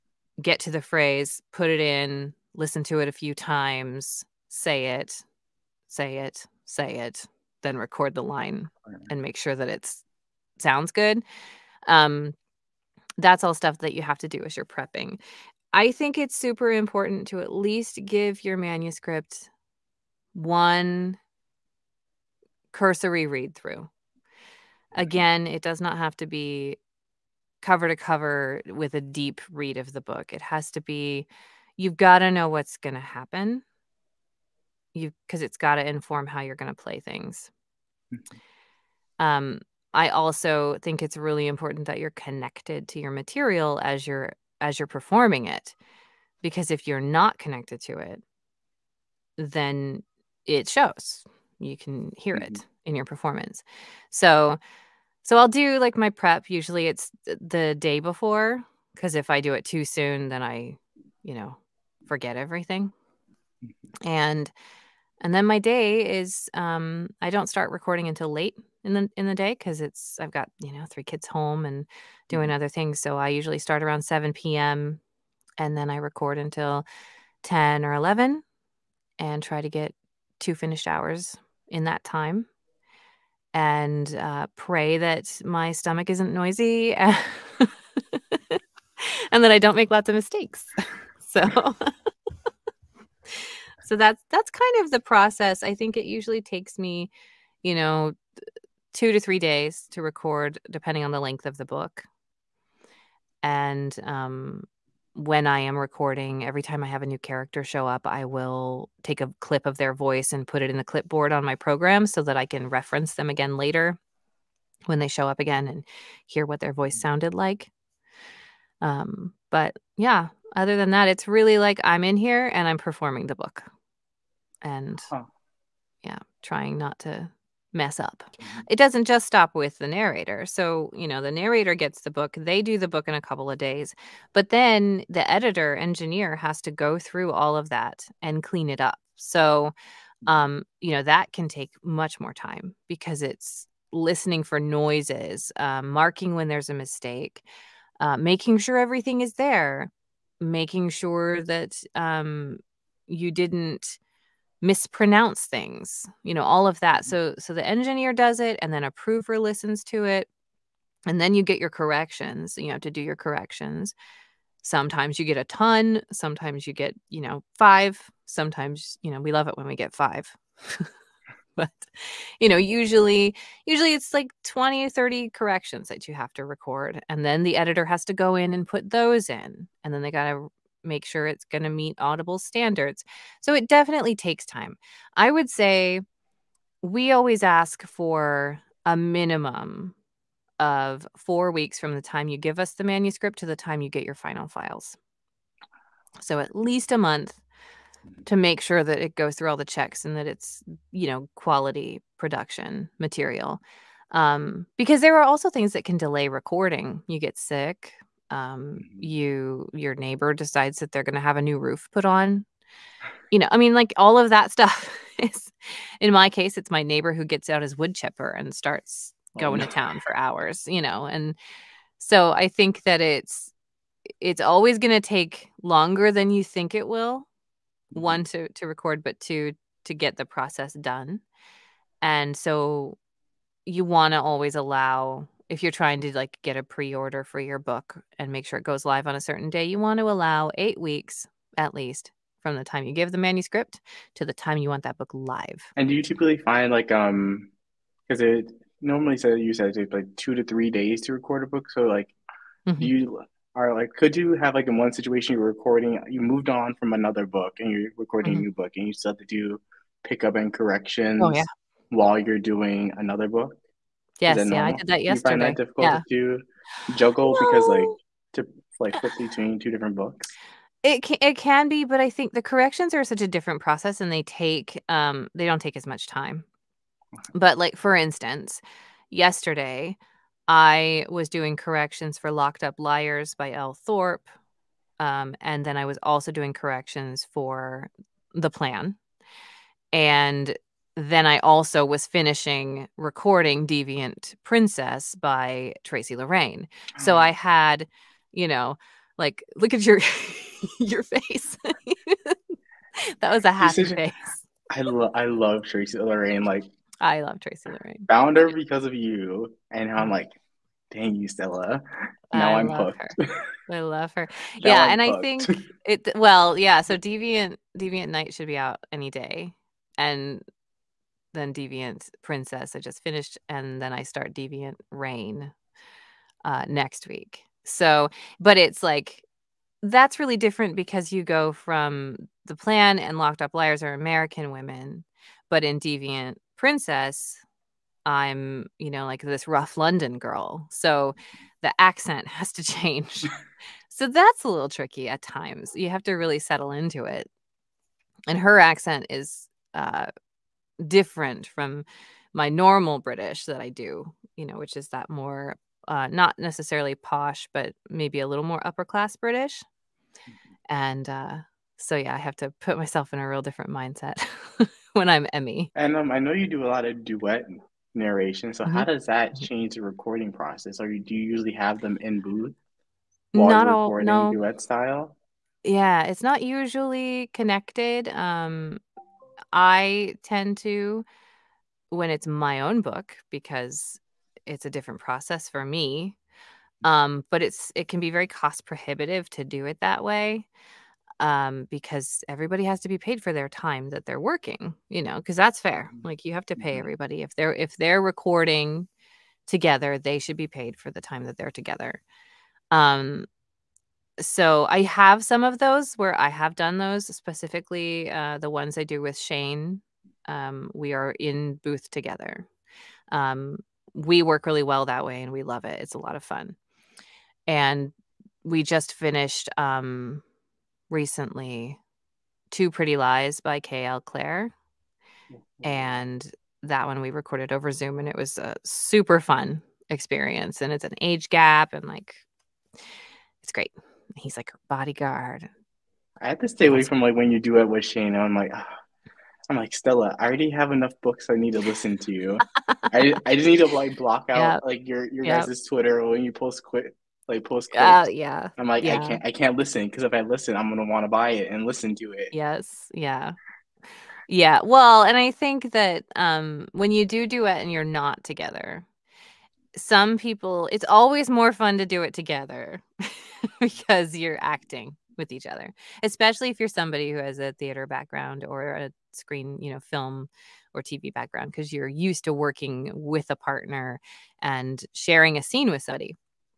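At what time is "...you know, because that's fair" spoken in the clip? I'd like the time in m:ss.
6:34.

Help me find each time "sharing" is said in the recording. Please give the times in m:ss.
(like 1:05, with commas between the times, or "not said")
7:54.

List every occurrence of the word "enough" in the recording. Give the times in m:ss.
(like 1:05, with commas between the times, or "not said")
7:20.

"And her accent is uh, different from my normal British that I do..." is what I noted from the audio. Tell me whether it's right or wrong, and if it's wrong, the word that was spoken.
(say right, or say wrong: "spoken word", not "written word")
right.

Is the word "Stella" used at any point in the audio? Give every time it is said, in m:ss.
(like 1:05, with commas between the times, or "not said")
5:11, 7:19.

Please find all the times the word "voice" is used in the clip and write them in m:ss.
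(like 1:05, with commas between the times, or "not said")
1:49, 1:56.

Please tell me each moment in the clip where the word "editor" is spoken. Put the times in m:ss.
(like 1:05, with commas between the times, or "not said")
2:15, 2:57.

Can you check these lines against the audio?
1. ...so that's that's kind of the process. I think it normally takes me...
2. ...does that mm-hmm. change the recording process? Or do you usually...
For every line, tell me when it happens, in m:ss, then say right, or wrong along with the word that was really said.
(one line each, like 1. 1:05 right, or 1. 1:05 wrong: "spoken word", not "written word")
1. 1:33 wrong: "usually", not "normally"
2. 6:08 right.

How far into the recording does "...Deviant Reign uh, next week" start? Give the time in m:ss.
5:24.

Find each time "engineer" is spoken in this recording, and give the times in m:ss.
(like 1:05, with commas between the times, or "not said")
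2:15, 2:37.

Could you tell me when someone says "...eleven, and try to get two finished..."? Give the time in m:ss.
1:17.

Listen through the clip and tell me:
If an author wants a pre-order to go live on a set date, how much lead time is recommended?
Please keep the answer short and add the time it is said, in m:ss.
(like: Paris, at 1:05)
8 weeks, at 4:00.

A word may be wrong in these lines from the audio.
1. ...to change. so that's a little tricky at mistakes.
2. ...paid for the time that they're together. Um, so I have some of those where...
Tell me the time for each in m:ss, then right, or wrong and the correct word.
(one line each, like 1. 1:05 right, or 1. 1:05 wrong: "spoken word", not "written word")
1. 5:42 wrong: "times", not "mistakes"
2. 6:40 right.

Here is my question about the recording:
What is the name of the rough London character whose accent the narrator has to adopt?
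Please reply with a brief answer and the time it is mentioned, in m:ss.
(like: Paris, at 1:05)
Emmy, at 6:05.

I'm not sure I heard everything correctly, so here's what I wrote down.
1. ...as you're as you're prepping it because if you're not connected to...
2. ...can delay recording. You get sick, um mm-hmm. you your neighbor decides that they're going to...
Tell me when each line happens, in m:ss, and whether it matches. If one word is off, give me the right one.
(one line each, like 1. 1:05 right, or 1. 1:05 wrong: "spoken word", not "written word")
1. 0:43 wrong: "performing", not "prepping"
2. 3:25 right.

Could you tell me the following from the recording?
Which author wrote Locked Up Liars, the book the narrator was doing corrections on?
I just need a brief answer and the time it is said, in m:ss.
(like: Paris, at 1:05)
Elle Thorpe, at 4:43.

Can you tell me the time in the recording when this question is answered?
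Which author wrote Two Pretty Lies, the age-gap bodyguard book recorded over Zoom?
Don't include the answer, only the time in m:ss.
7:03.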